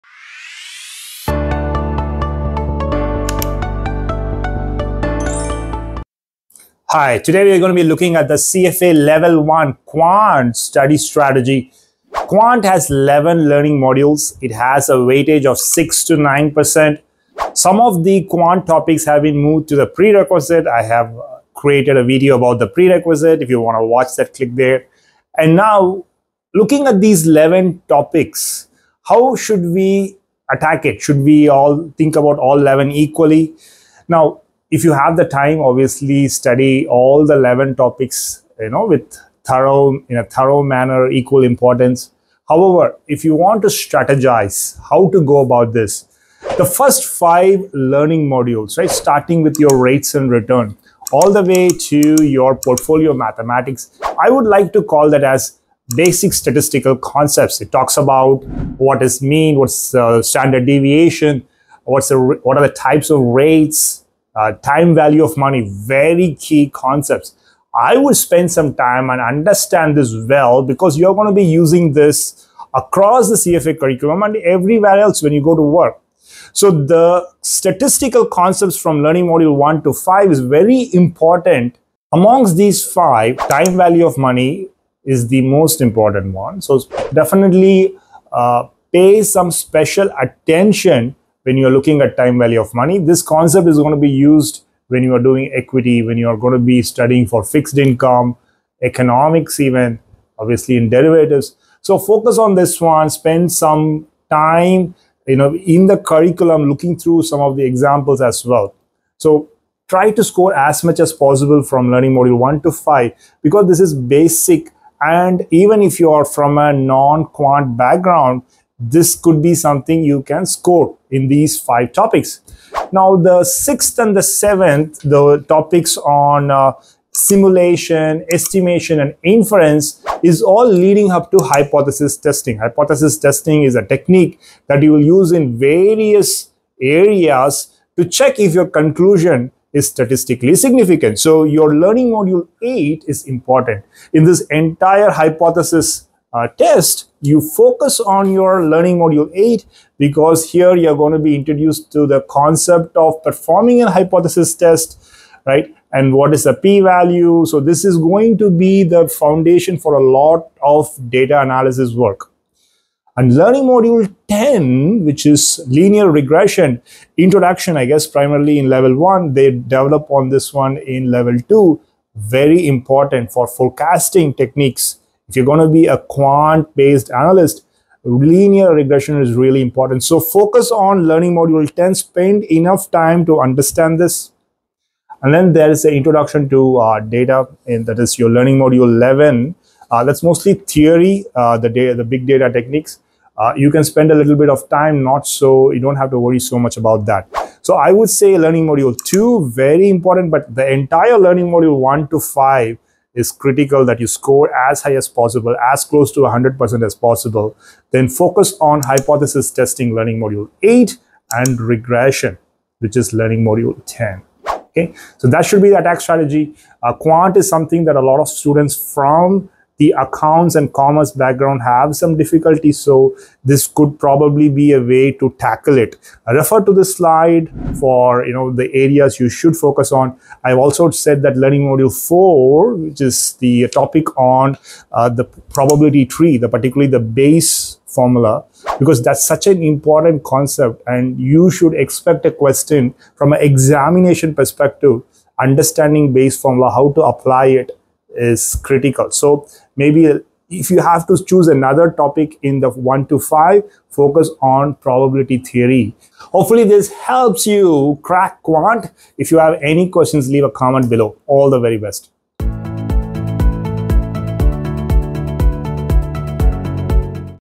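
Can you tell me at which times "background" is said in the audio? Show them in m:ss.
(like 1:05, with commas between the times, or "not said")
1:57, 3:41.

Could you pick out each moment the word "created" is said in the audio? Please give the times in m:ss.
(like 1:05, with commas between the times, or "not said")
0:21.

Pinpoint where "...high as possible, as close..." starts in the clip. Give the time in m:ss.
3:24.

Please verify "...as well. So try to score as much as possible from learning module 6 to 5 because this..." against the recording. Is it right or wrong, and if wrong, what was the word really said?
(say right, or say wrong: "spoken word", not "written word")
wrong: "1", not "6".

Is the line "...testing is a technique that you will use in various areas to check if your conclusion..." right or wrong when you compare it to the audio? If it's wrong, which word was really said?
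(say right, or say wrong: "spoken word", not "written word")
right.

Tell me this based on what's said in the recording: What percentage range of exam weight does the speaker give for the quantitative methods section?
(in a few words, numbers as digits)
6 to 9%.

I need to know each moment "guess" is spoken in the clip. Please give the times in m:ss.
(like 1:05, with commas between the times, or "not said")
2:47.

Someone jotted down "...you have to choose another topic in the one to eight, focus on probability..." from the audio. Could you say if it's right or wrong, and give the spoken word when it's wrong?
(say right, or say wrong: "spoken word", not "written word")
wrong: "five", not "eight".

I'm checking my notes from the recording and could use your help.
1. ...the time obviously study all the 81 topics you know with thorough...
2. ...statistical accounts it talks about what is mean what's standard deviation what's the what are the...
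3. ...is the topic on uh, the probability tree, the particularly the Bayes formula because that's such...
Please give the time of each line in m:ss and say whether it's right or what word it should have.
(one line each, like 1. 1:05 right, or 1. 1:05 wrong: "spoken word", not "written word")
1. 0:35 wrong: "11", not "81"
2. 0:56 wrong: "concepts", not "accounts"
3. 3:53 right.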